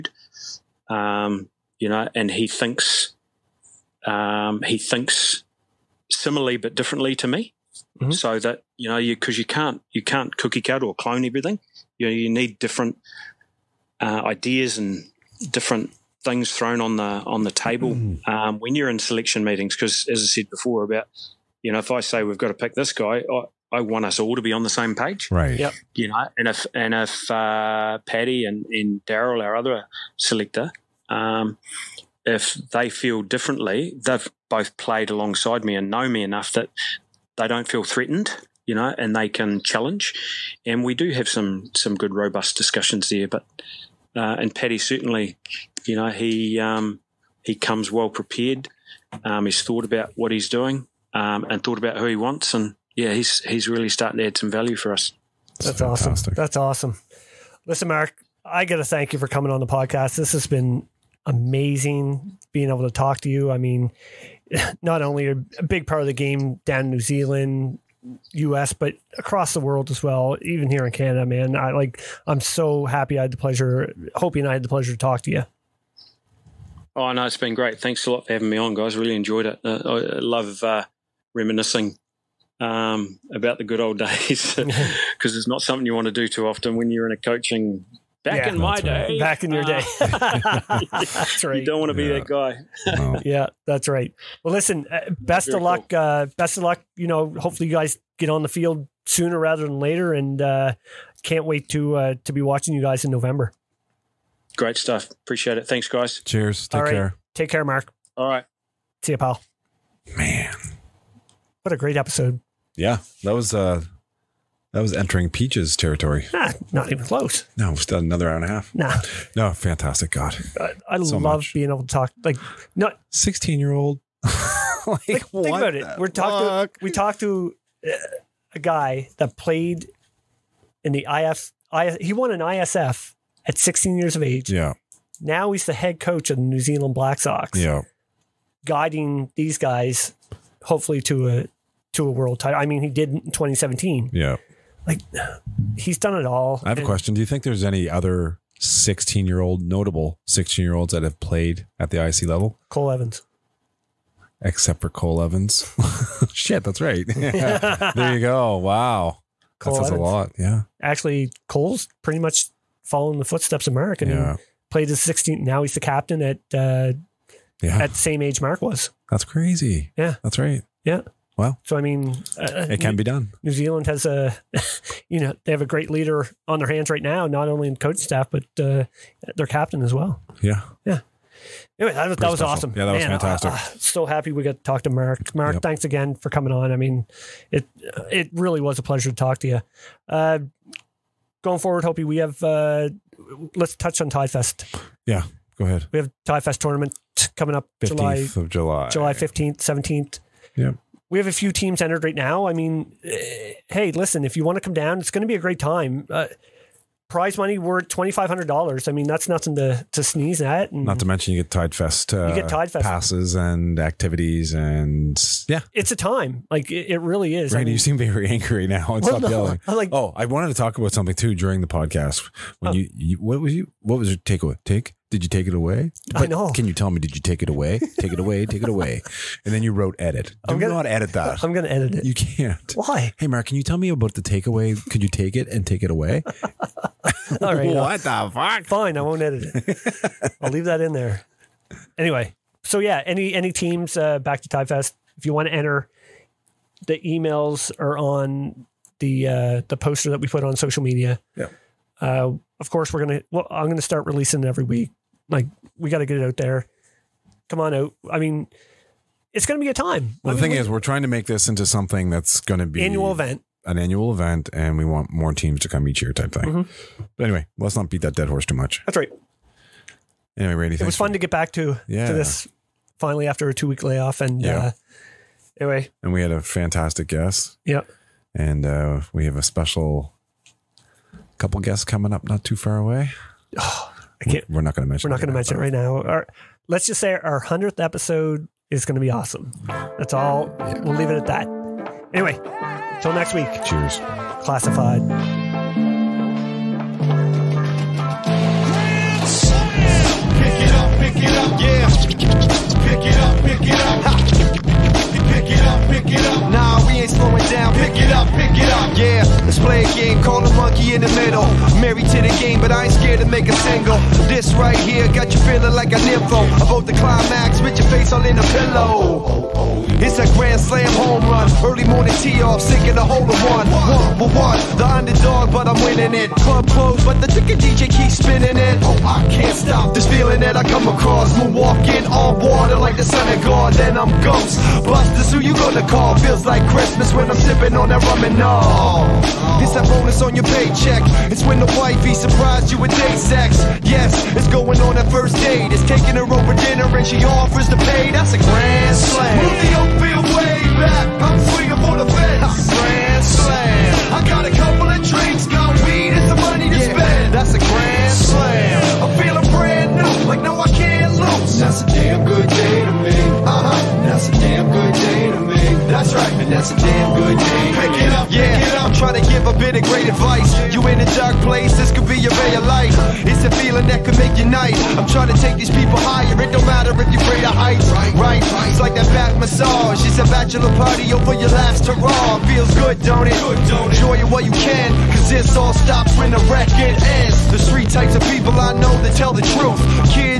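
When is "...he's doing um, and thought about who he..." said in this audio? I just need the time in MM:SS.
00:50.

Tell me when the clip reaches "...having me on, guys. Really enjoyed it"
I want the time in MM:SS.
01:18.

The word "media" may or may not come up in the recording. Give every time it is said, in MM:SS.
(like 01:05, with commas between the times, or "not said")
04:10.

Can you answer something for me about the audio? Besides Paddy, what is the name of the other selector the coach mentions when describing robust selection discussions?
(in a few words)
Daryl.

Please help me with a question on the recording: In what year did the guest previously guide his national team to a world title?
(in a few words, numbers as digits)
2017.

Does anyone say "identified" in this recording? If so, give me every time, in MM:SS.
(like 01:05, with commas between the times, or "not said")
not said.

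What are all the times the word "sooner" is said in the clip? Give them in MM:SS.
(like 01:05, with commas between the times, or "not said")
01:39.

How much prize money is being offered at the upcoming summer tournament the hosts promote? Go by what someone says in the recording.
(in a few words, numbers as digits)
$2,500.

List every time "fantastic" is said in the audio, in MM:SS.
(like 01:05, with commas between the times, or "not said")
01:59, 03:03, 04:36.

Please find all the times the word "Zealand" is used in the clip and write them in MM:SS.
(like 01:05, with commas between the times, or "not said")
01:06, 02:16, 02:53.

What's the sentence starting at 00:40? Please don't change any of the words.
And we do have some some good robust discussions there.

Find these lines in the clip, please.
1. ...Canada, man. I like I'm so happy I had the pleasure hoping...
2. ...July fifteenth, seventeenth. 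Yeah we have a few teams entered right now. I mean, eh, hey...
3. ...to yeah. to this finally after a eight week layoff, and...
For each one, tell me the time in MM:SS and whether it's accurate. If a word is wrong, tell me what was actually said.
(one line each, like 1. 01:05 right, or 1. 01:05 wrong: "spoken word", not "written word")
1. 01:10 right
2. 03:18 right
3. 04:31 wrong: "two", not "eight".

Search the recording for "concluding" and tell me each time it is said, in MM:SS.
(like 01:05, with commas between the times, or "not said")
not said.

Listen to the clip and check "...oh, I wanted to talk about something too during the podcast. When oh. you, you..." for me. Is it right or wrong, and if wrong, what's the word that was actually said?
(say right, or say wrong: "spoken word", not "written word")
right.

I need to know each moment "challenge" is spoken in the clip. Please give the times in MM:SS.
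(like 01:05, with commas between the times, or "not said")
00:39.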